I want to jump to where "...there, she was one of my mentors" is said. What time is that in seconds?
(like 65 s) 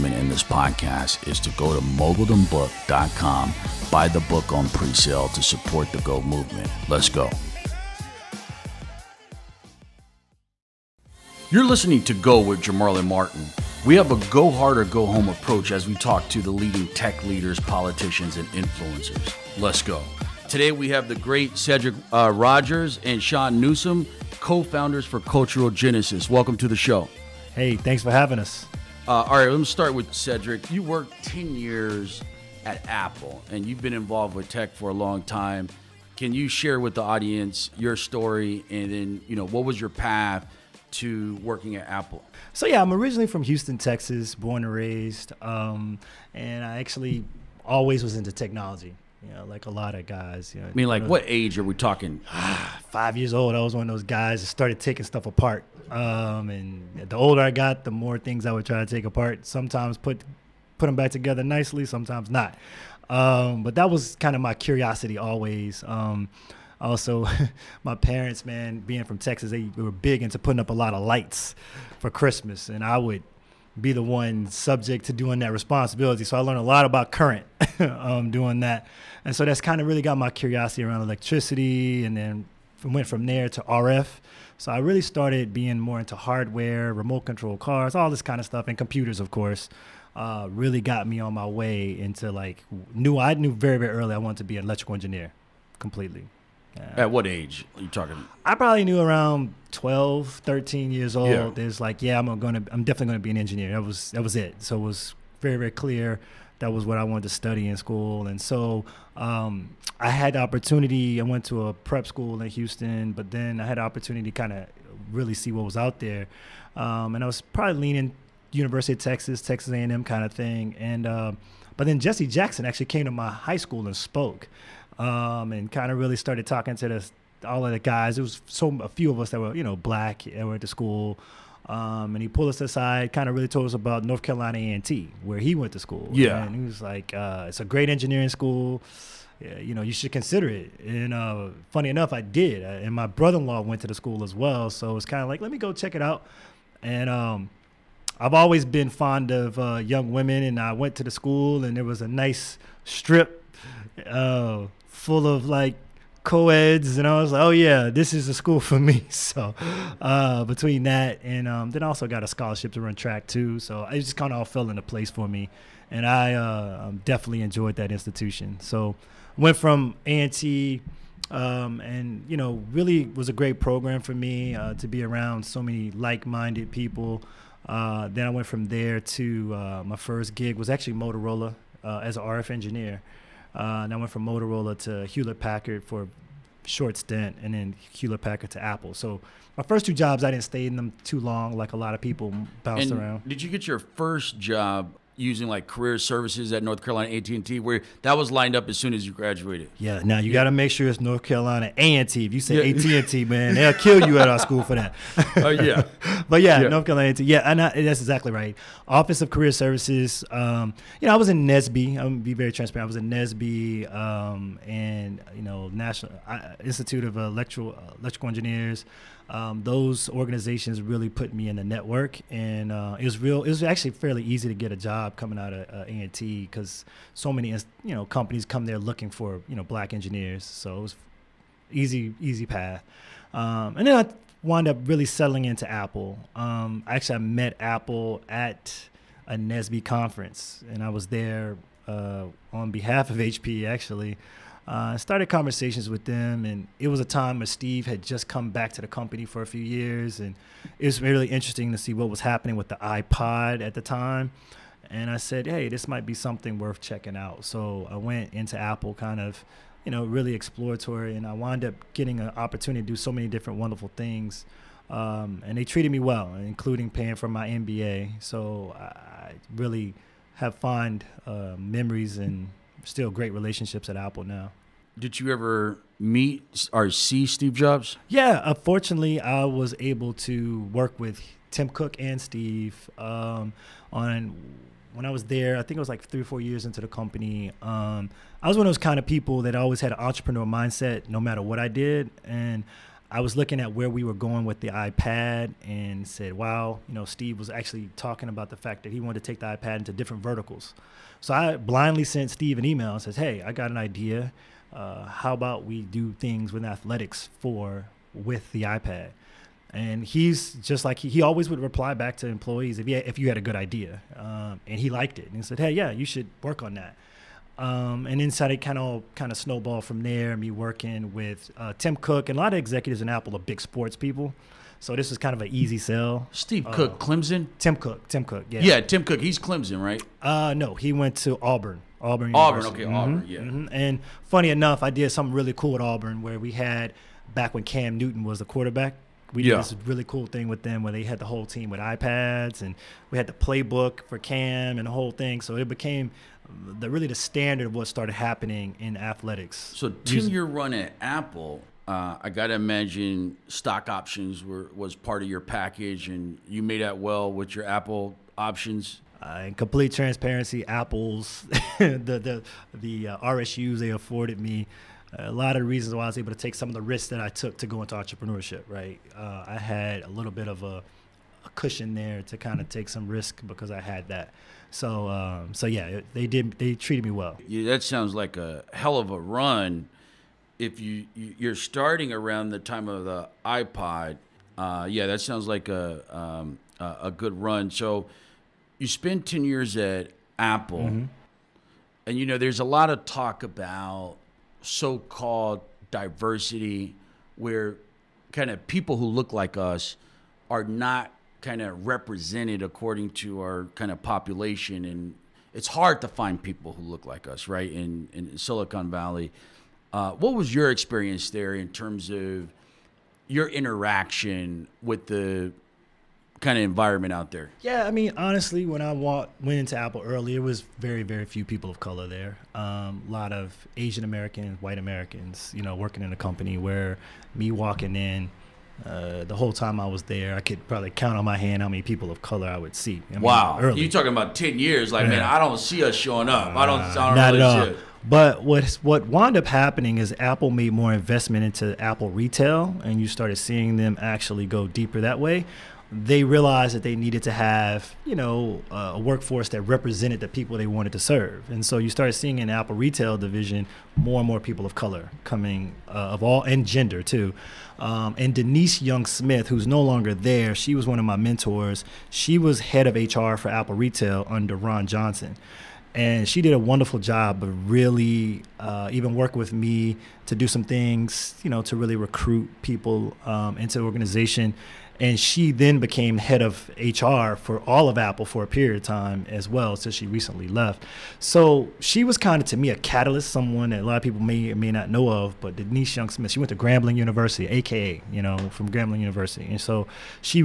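460 s.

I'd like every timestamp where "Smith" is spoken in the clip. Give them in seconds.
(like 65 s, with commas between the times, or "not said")
459 s, 486 s.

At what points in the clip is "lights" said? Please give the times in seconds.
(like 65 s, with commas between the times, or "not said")
71 s.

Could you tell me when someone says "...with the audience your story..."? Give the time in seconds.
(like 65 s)
36 s.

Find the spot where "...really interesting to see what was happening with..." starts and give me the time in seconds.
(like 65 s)
251 s.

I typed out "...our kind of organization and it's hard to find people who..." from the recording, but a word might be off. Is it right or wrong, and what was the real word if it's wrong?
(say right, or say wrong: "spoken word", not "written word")
wrong: "population", not "organization".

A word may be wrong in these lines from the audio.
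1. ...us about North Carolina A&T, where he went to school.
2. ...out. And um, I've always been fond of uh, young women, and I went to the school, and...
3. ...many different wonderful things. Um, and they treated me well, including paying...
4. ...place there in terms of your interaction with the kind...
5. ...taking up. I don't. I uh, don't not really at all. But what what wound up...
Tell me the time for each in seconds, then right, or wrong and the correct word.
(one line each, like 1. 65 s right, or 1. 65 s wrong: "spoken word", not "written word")
1. 133 s right
2. 146 s right
3. 263 s right
4. 410 s wrong: "experience", not "place"
5. 435 s wrong: "showing", not "taking".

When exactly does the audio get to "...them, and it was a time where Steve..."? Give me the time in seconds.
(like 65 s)
246 s.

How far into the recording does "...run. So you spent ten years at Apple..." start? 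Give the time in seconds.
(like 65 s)
387 s.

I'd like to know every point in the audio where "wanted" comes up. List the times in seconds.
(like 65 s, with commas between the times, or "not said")
94 s, 107 s, 299 s, 450 s.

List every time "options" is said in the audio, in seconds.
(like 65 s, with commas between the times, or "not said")
353 s, 358 s.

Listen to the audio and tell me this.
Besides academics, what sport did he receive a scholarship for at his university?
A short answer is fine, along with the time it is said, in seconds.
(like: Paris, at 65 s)
Track, at 162 s.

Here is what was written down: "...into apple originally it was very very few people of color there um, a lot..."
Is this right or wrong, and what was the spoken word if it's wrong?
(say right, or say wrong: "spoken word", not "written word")
wrong: "early", not "originally".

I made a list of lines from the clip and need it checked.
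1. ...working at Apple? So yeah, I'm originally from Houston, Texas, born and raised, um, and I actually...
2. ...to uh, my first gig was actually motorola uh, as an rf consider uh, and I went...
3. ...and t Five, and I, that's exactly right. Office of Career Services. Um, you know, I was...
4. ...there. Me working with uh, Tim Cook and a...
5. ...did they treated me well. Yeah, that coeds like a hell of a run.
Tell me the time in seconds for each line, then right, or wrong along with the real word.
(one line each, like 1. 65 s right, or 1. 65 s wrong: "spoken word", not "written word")
1. 41 s right
2. 179 s wrong: "engineer", not "consider"
3. 207 s wrong: "Yeah", not "Five"
4. 320 s right
5. 376 s wrong: "sounds", not "coeds".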